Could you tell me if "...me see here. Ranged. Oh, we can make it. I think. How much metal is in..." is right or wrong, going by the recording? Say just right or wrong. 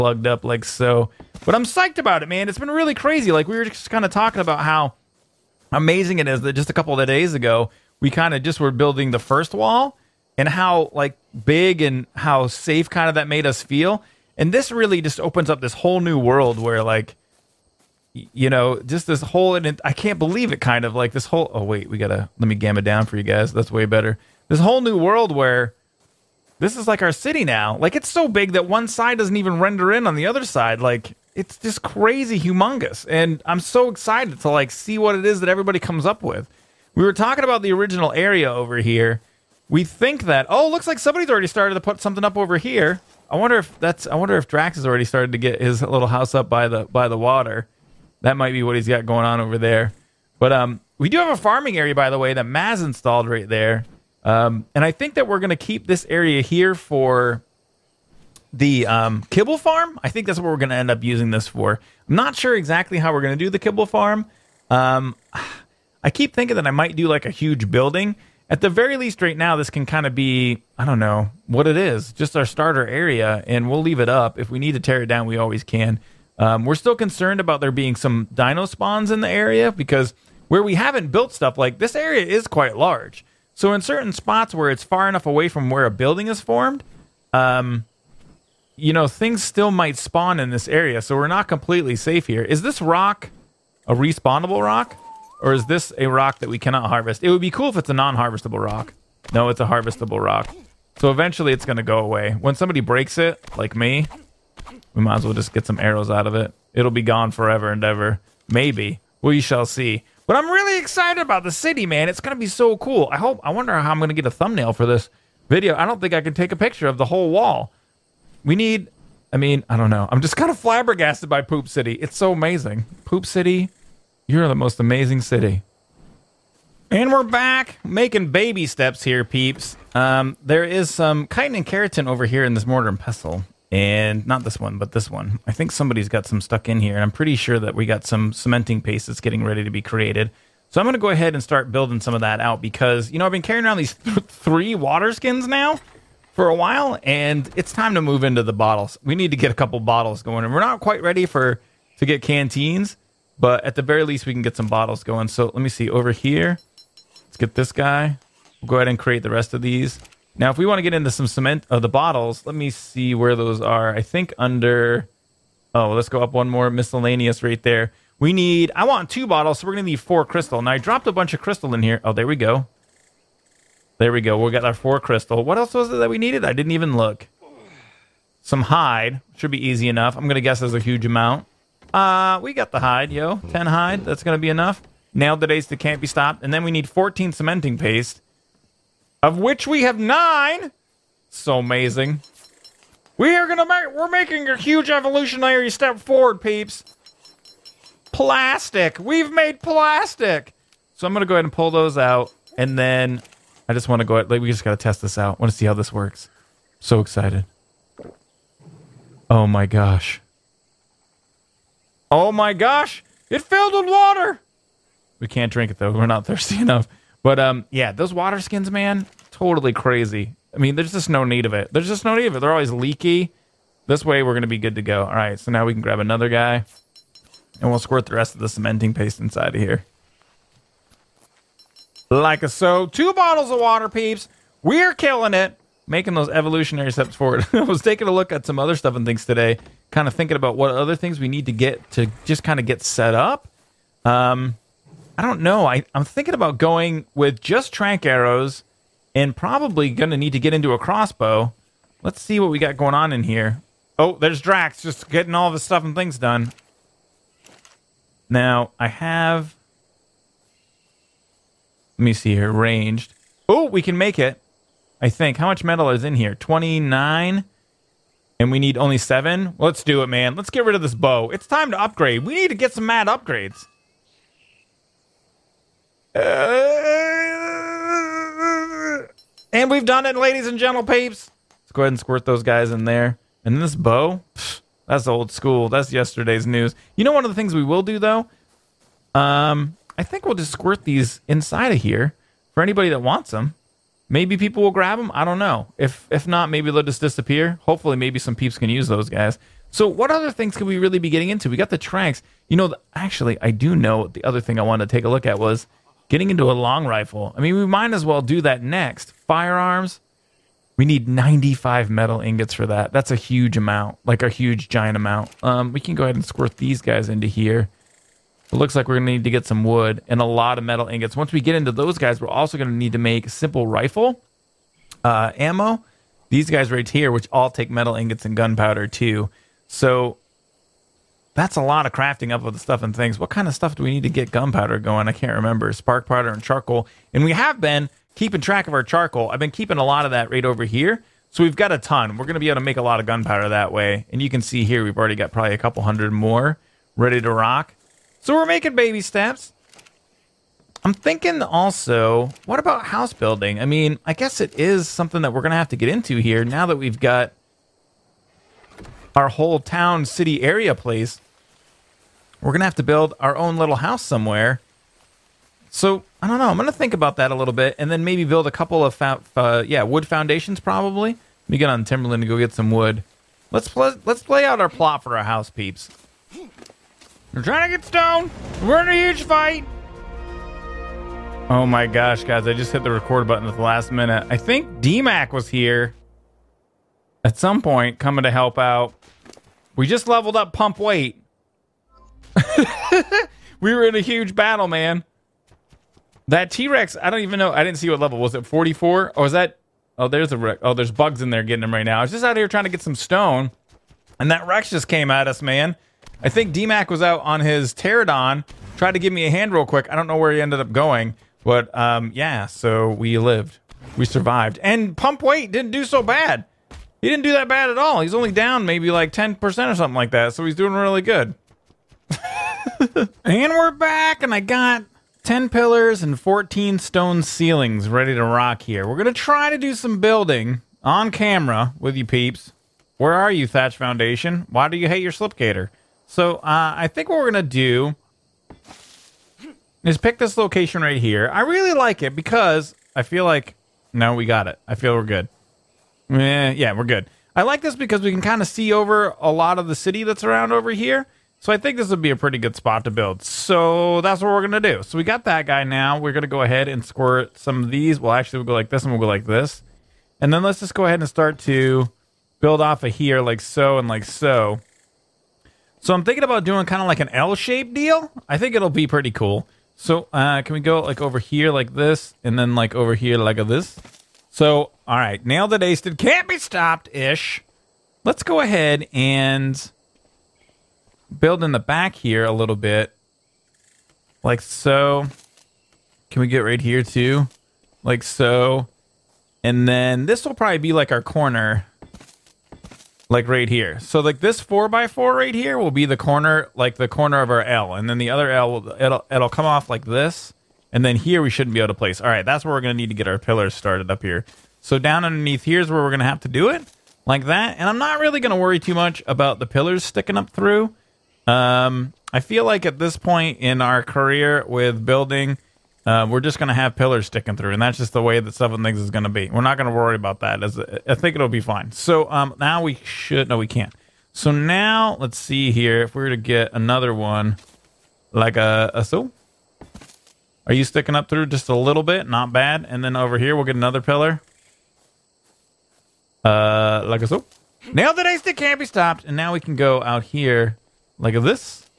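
right.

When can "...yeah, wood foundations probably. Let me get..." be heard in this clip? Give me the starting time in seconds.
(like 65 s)
369 s.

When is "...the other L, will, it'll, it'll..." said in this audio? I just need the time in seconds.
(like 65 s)
497 s.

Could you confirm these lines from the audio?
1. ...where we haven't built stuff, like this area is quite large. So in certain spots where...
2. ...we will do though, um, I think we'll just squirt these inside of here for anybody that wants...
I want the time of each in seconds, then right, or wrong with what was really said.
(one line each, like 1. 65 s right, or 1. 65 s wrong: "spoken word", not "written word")
1. 80 s right
2. 287 s right.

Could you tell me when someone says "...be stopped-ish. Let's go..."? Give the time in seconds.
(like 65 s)
476 s.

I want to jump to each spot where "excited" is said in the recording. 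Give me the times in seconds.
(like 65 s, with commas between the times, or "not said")
33 s, 110 s, 207 s.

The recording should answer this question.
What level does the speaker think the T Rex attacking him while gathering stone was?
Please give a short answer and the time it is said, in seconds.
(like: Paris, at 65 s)
44, at 398 s.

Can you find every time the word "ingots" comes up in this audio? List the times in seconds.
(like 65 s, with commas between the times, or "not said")
312 s, 320 s, 327 s.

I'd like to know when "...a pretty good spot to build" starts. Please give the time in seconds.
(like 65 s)
452 s.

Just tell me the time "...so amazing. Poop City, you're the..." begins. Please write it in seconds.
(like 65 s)
122 s.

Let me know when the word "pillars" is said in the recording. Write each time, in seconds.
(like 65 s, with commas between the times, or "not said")
425 s, 503 s, 509 s, 516 s, 533 s.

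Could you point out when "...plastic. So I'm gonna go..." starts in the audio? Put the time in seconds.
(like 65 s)
199 s.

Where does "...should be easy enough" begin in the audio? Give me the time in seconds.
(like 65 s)
179 s.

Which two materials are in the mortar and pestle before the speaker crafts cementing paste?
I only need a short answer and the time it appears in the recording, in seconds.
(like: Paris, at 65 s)
chitin and keratin, at 131 s.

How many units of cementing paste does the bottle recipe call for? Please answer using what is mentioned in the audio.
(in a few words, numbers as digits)
14.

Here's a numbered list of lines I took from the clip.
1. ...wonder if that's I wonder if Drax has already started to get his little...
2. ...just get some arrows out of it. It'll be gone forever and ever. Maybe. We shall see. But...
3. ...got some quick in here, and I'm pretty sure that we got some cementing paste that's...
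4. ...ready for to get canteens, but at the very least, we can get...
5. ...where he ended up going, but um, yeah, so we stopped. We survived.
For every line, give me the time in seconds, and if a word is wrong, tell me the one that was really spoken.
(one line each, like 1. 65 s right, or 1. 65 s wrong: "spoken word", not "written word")
1. 43 s right
2. 105 s right
3. 136 s wrong: "stuck", not "quick"
4. 151 s right
5. 410 s wrong: "lived", not "stopped".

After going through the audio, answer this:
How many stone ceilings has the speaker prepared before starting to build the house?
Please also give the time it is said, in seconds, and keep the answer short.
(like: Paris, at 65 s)
14, at 426 s.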